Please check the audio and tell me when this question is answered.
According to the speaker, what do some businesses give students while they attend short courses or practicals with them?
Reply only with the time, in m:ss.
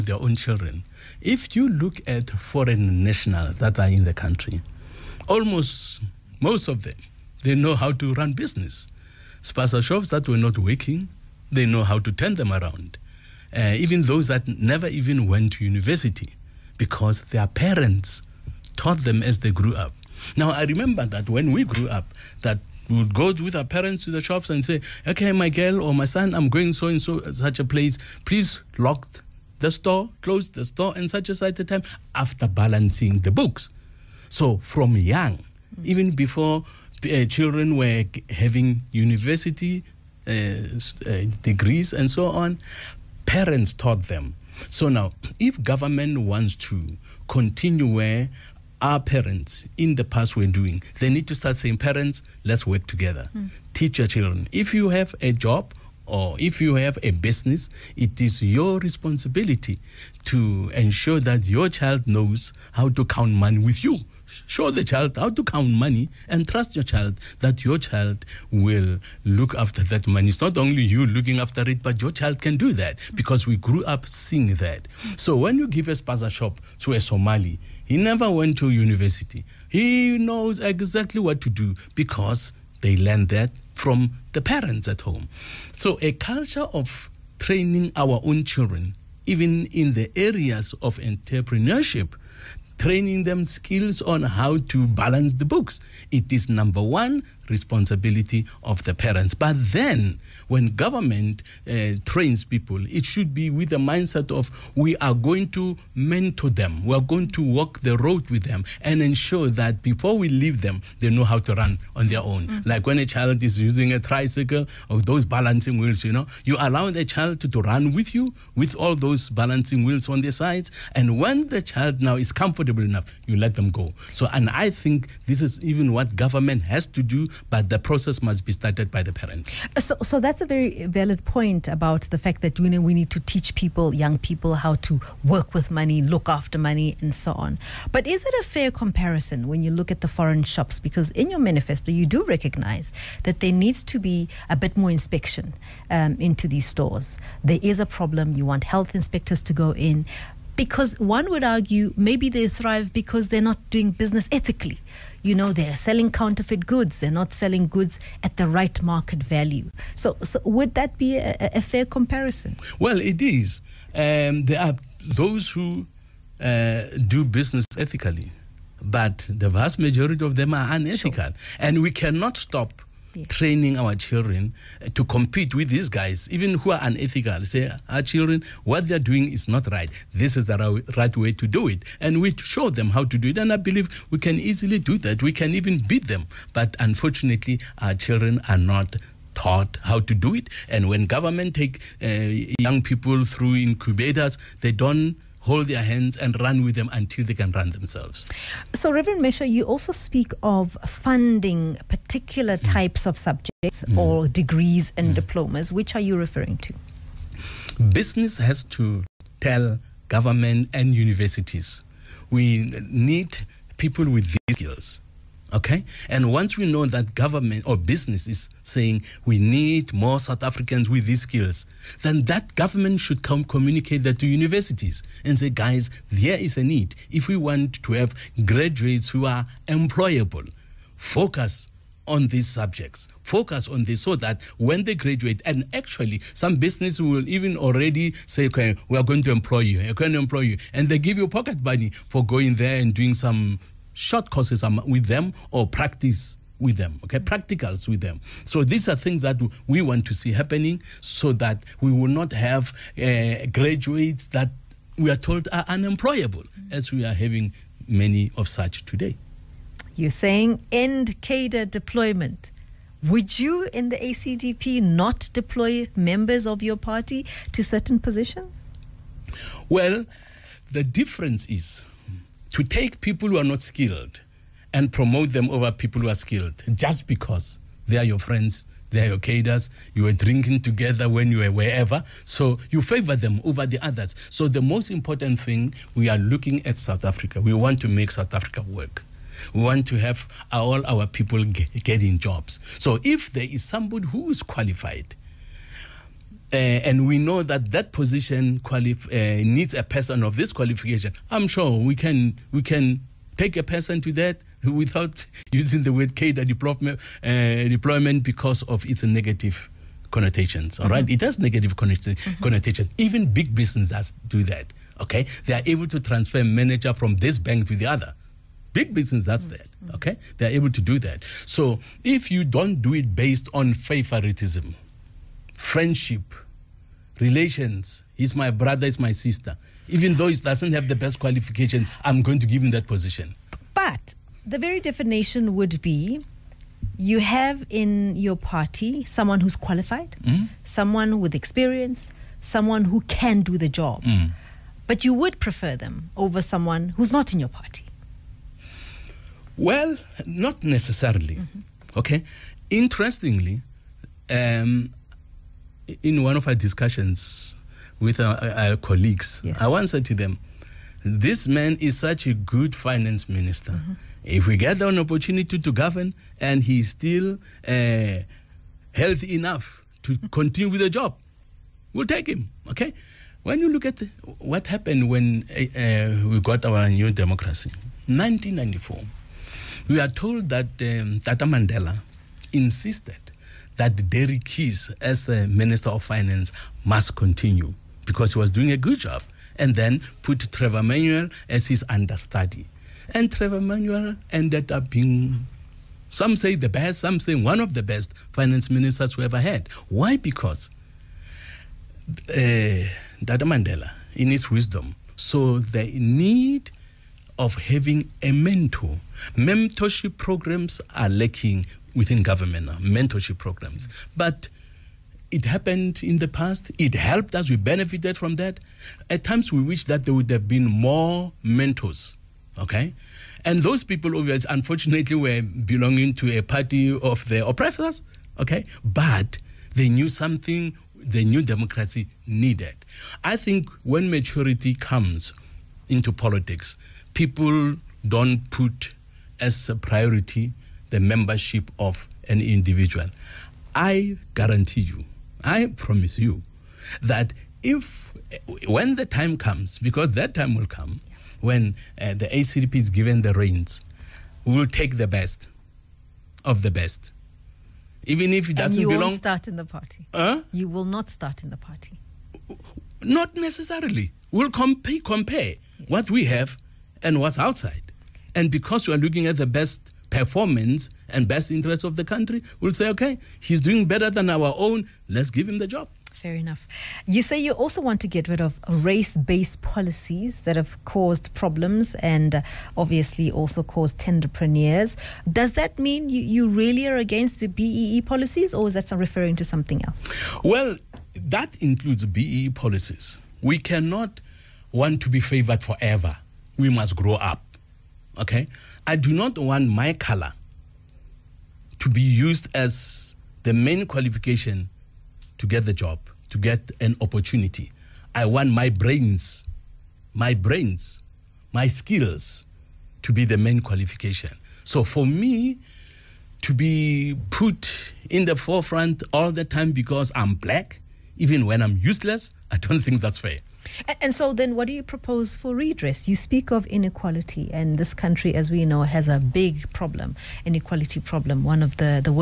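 4:01.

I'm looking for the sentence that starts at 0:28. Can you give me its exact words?
Please lock the store, close the store, and such a such a time after balancing the books.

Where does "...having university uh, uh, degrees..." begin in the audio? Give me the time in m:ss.
0:38.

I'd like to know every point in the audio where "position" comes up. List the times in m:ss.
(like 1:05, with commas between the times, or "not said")
4:27, 4:57, 5:32.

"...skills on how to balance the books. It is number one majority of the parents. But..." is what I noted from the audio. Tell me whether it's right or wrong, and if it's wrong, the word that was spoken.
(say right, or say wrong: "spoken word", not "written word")
wrong: "responsibility", not "majority".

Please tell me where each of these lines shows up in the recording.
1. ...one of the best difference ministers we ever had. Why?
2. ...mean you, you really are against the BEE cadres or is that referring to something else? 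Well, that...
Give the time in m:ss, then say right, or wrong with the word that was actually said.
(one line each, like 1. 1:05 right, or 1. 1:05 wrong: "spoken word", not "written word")
1. 6:37 wrong: "finance", not "difference"
2. 8:05 wrong: "policies", not "cadres".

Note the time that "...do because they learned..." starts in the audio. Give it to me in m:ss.
1:21.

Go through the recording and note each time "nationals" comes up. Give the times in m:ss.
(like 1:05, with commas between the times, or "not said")
0:03.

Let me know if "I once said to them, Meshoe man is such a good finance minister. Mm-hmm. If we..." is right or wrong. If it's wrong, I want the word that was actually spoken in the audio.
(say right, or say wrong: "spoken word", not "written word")
wrong: "This", not "Meshoe".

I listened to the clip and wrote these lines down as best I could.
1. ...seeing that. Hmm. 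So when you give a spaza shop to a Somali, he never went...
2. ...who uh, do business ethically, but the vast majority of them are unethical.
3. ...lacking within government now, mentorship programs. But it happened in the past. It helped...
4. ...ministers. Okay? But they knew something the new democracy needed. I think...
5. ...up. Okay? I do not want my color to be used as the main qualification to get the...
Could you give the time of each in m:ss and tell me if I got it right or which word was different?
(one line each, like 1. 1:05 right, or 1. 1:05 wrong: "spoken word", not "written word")
1. 1:14 right
2. 2:45 right
3. 6:51 right
4. 7:07 wrong: "oppressors", not "ministers"
5. 8:17 right.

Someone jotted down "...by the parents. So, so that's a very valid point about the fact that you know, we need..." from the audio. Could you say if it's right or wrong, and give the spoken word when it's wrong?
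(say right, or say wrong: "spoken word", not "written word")
right.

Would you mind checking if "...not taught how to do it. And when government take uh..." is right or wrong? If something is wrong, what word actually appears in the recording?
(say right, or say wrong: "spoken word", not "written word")
right.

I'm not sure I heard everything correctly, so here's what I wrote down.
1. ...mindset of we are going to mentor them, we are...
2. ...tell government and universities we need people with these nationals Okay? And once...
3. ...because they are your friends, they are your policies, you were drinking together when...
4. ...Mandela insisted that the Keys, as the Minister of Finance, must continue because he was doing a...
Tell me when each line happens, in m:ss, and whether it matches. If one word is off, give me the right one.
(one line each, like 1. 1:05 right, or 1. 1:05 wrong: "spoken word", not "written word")
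1. 1:43 right
2. 3:29 wrong: "skills", not "nationals"
3. 4:37 wrong: "cadres", not "policies"
4. 6:21 right.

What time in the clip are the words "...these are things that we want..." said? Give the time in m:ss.
4:08.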